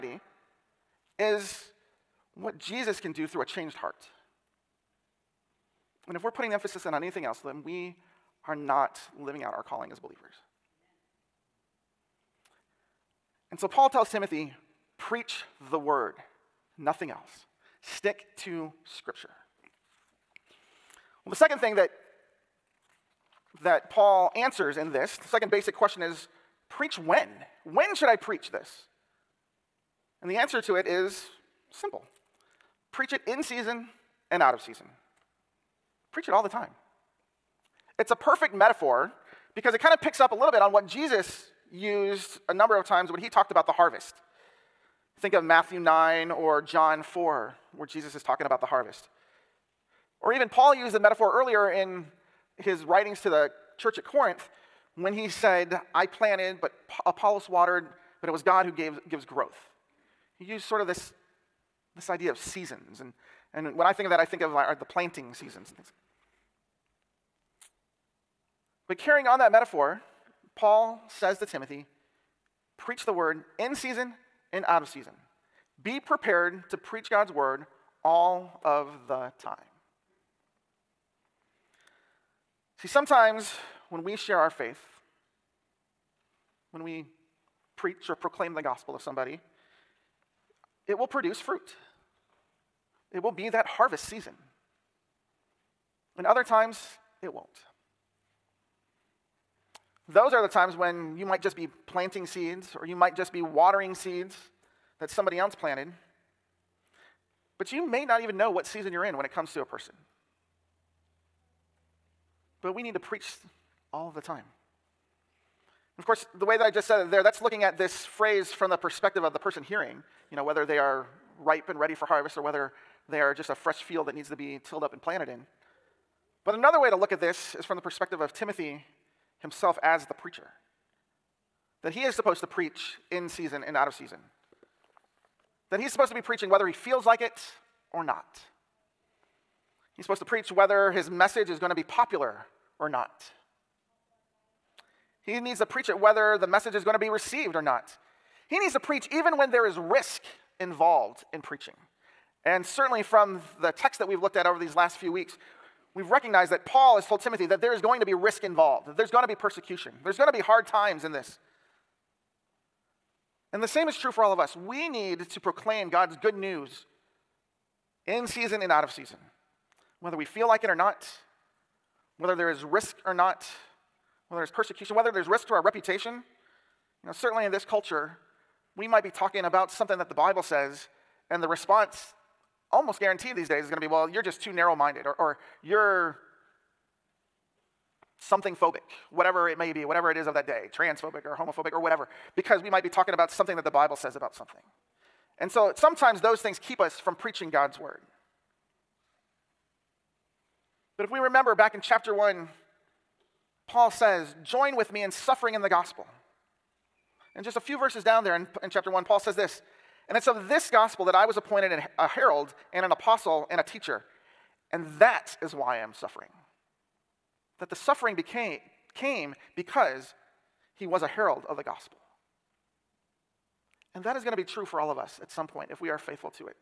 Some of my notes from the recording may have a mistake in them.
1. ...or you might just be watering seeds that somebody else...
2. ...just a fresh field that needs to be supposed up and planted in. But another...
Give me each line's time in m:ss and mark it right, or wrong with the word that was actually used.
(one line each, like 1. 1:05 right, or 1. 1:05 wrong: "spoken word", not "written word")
1. 1:42 right
2. 2:03 wrong: "tilled", not "supposed".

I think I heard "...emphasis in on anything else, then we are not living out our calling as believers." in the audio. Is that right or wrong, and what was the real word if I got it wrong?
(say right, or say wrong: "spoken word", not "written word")
right.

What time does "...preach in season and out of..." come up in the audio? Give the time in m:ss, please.
2:12.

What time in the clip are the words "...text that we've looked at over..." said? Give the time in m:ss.
2:33.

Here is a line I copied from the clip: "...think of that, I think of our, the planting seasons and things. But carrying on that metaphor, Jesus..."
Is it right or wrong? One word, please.
wrong.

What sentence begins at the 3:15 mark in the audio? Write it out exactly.
And so sometimes those things keep us from preaching God's word.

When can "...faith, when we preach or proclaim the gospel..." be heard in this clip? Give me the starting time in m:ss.
1:24.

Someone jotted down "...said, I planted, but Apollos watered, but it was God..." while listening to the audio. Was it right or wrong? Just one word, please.
right.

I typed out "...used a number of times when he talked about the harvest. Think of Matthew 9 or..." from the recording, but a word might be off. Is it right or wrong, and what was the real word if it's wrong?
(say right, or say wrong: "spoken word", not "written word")
right.